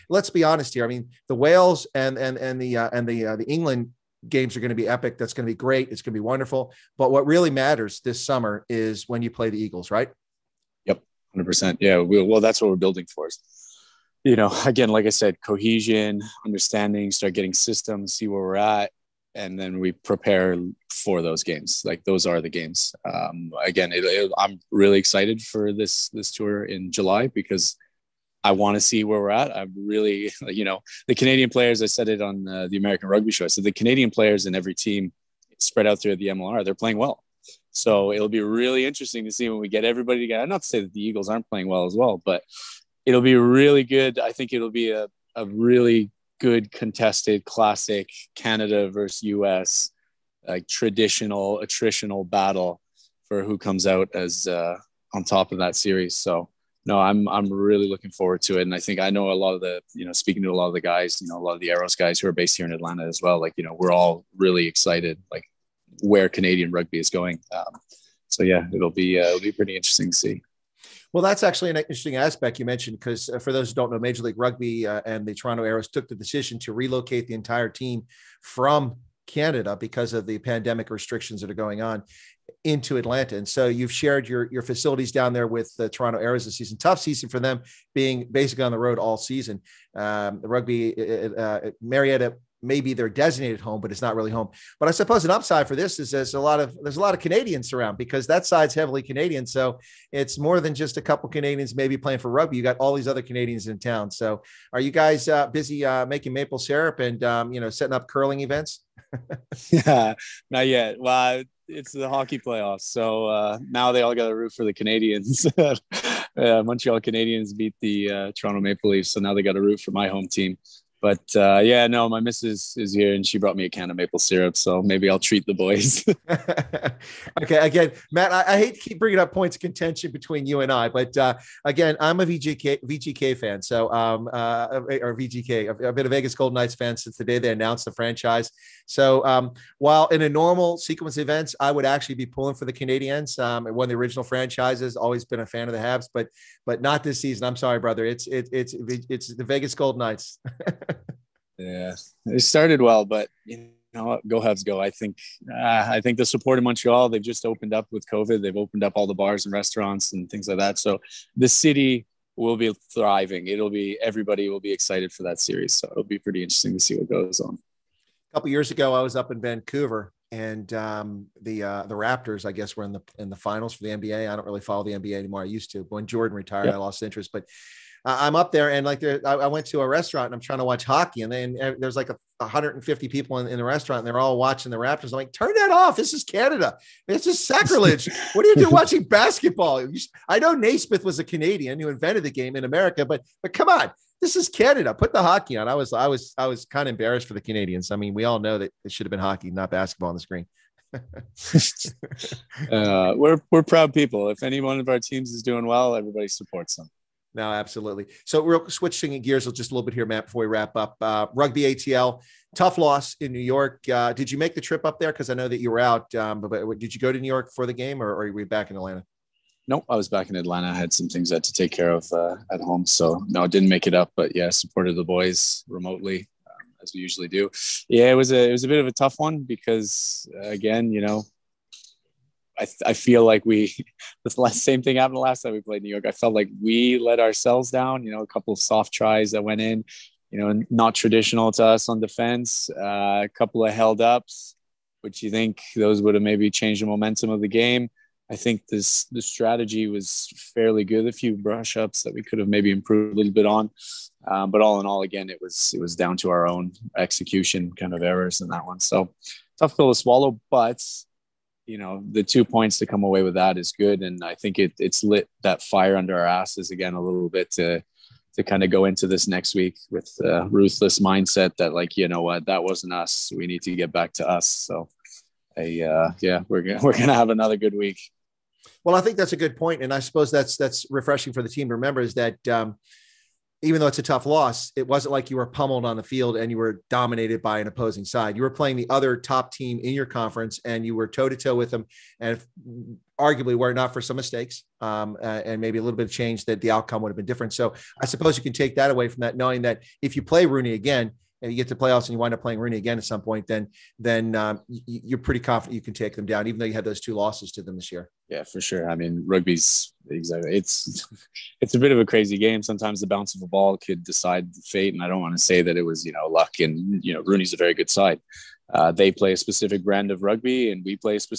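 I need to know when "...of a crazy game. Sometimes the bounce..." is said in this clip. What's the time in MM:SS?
05:11.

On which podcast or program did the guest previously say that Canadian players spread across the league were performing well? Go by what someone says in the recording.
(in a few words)
The American Rugby Show.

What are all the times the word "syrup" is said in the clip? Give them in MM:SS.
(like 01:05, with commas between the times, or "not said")
01:46, 02:04.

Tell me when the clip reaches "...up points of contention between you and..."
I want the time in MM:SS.
02:09.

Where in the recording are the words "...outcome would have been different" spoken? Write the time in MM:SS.
04:56.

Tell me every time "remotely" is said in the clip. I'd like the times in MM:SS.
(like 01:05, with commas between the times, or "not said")
03:45.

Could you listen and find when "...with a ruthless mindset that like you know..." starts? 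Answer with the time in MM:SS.
04:29.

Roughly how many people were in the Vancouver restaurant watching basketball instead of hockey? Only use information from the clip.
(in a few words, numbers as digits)
150.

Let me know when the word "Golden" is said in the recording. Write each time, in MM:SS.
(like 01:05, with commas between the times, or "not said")
02:16, 02:29.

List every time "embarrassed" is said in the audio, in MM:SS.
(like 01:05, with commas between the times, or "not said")
03:16.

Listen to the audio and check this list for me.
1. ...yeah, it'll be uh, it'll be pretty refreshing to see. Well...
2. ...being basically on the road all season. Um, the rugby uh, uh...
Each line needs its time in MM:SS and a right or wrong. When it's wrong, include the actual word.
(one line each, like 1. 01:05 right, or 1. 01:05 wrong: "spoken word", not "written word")
1. 01:08 wrong: "interesting", not "refreshing"
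2. 01:27 right.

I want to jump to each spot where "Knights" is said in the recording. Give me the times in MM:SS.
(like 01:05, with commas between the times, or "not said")
02:16, 02:29.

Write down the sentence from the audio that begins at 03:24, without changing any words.
If any one of our teams is doing well, everybody supports them no, absolutely.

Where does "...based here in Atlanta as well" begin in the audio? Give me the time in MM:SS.
01:02.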